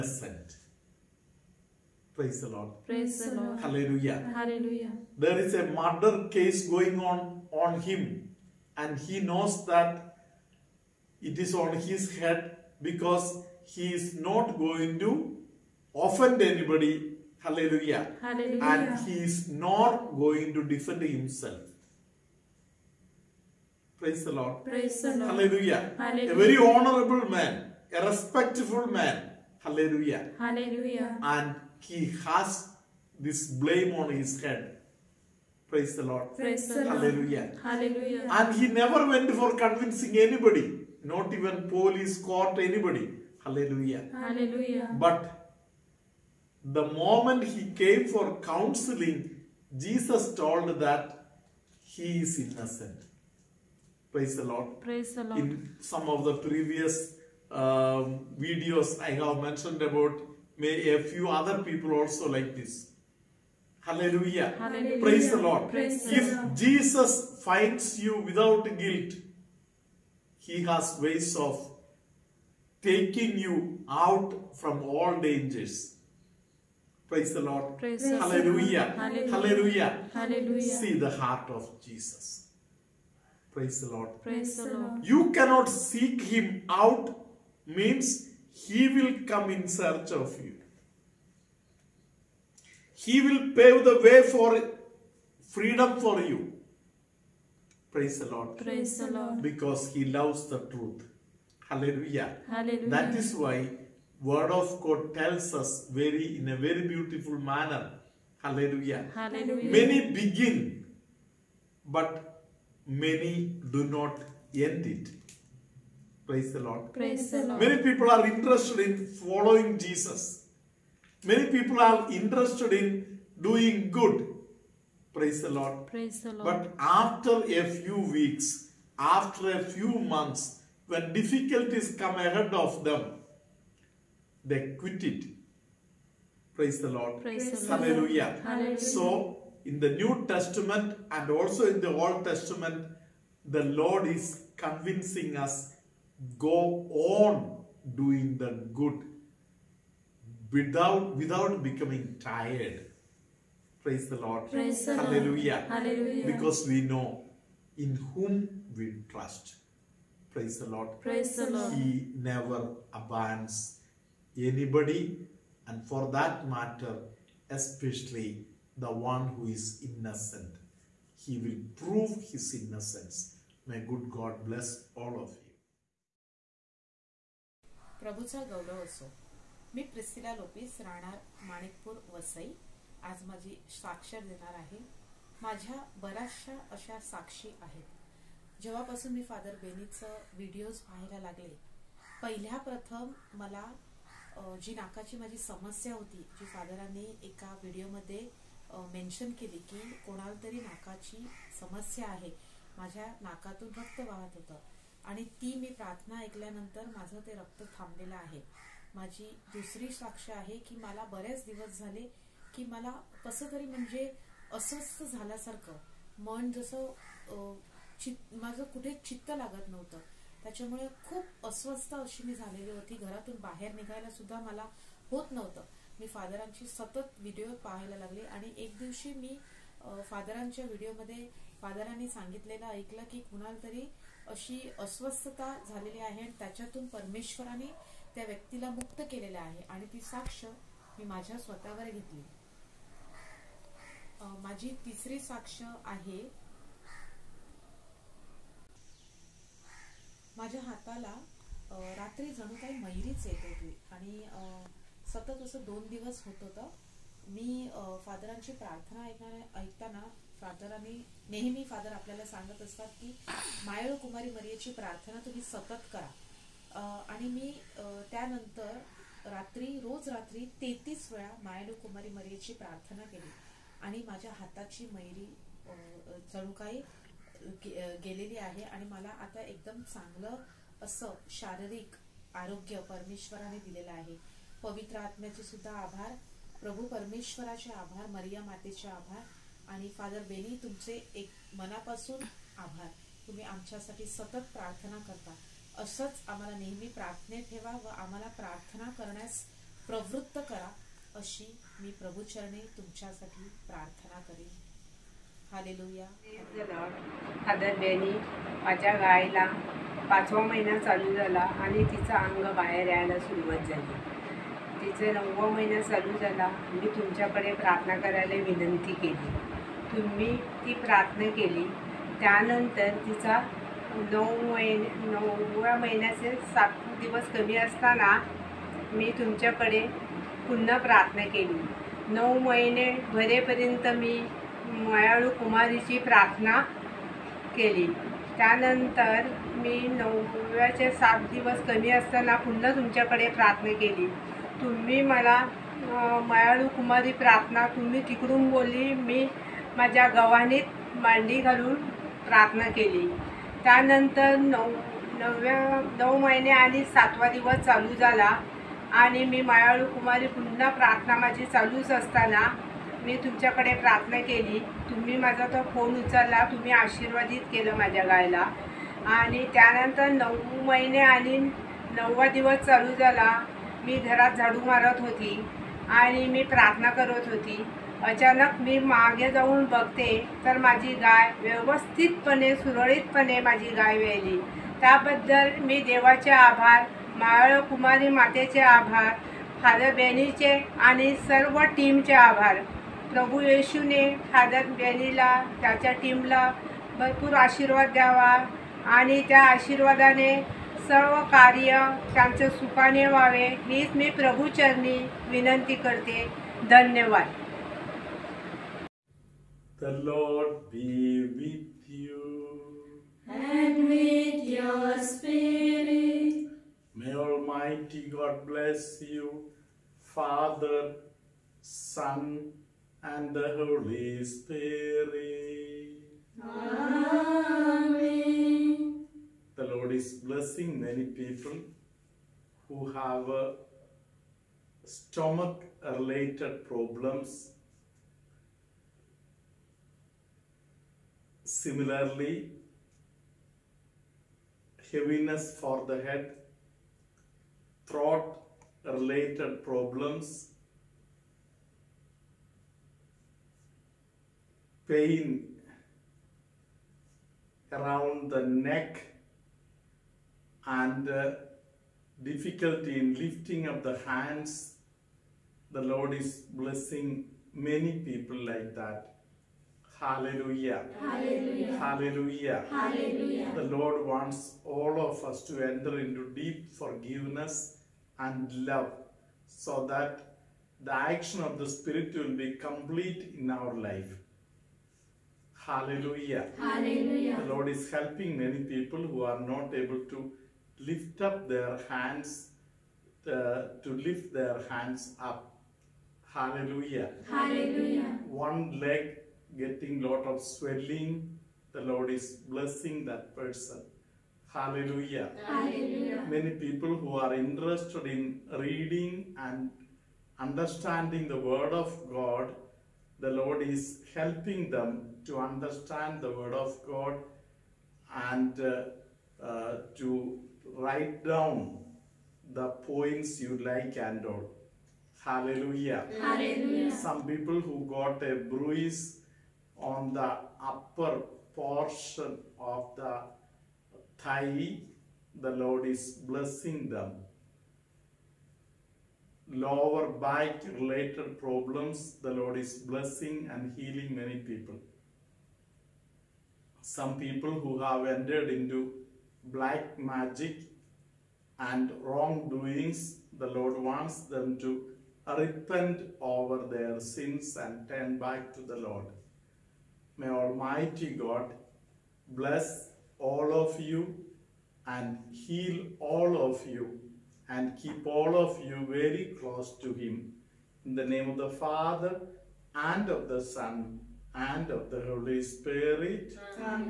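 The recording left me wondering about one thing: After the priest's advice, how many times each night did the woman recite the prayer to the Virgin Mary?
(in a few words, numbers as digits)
33.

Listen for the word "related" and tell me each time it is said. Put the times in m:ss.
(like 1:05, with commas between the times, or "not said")
7:14, 7:28, 9:00.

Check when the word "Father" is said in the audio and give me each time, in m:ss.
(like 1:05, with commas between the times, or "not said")
7:00, 9:31.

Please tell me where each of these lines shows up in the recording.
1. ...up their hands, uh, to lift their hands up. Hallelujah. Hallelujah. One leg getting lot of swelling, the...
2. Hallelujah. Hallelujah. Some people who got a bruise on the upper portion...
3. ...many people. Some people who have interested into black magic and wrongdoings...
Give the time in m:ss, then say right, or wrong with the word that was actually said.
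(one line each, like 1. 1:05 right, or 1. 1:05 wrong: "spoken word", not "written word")
1. 8:11 right
2. 8:45 right
3. 9:04 wrong: "entered", not "interested".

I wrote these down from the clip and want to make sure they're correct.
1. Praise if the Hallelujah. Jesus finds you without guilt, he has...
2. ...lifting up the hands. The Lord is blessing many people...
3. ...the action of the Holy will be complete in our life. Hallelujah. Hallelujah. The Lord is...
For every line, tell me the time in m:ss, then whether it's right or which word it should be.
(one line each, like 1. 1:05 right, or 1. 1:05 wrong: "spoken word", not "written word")
1. 1:05 wrong: "Lord", not "Hallelujah"
2. 7:43 right
3. 8:00 wrong: "Spirit", not "Holy".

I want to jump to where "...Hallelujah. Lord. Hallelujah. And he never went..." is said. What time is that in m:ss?
0:36.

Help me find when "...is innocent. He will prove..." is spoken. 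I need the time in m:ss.
2:49.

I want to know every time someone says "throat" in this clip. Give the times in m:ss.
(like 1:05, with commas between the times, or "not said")
7:27.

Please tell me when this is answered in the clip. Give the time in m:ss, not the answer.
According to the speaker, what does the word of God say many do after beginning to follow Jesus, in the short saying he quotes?
1:52.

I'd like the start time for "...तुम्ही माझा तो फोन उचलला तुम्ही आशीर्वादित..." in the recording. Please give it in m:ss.
6:04.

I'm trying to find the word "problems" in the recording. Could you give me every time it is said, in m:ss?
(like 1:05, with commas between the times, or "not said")
7:16, 7:29, 9:01.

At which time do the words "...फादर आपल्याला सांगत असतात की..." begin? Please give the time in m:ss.
4:21.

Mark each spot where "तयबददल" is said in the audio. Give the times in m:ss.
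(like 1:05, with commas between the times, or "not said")
6:24.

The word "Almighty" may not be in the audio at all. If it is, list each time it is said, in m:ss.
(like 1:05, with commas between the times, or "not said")
6:57, 9:20.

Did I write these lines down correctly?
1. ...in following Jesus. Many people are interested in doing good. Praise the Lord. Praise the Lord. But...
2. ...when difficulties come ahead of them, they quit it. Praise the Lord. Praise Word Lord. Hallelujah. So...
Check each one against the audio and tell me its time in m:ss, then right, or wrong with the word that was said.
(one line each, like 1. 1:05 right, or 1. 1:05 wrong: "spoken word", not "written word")
1. 1:58 right
2. 2:10 wrong: "The", not "Word".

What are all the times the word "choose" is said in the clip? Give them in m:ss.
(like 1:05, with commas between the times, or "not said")
not said.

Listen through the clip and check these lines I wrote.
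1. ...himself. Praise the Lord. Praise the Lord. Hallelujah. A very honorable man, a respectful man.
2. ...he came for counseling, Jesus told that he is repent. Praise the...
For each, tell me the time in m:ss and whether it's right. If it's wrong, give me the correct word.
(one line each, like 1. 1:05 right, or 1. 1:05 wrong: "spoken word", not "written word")
1. 0:21 right
2. 0:47 wrong: "innocent", not "repent".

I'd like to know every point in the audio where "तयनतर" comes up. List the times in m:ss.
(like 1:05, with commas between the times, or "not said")
4:28, 5:22, 5:38, 5:53, 6:09.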